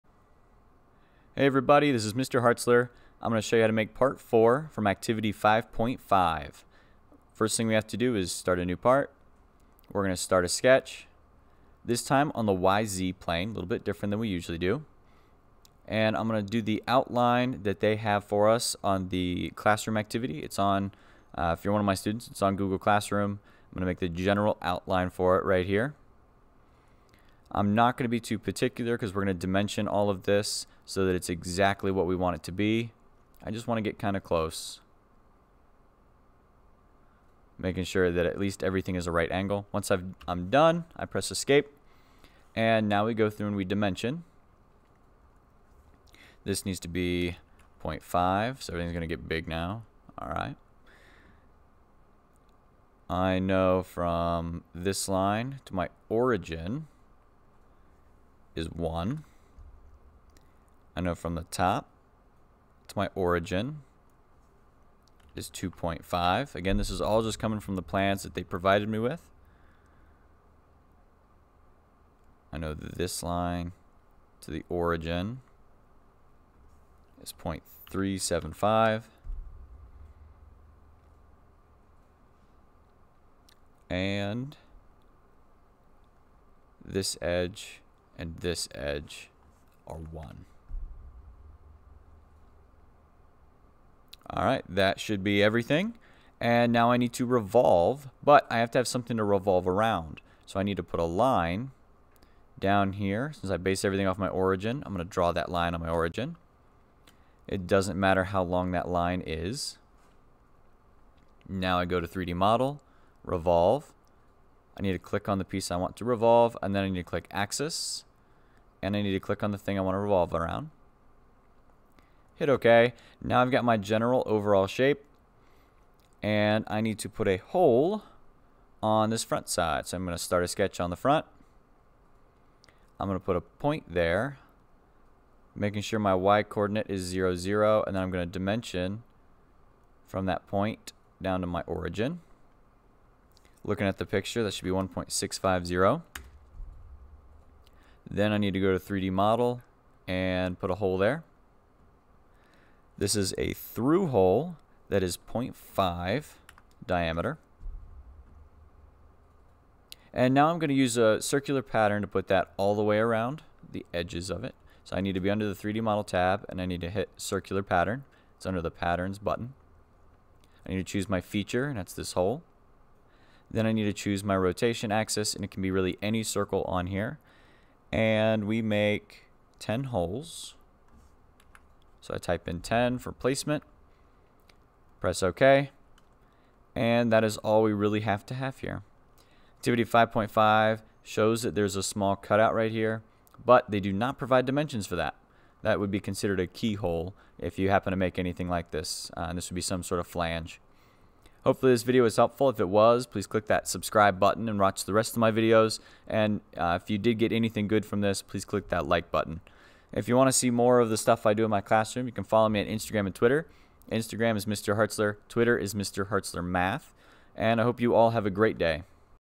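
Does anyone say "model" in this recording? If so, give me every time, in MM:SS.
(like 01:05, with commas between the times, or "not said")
01:52, 02:29, 02:45.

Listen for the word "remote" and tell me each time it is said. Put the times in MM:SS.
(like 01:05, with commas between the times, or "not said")
not said.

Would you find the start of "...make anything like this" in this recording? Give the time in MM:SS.
03:17.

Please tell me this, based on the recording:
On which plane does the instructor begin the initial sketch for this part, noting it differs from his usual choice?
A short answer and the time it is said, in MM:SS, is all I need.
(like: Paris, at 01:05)
YZ plane, at 00:12.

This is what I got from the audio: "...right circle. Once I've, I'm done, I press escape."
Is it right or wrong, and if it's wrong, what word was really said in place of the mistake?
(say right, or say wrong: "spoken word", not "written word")
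wrong: "angle", not "circle".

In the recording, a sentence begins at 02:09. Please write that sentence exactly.
So I'm going to start a sketch on the front.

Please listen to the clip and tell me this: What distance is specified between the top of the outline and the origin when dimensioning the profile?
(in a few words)
2.5.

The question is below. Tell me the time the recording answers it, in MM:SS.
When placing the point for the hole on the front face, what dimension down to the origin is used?
02:24.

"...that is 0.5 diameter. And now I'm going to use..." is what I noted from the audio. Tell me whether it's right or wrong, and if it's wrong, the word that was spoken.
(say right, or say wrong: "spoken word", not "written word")
right.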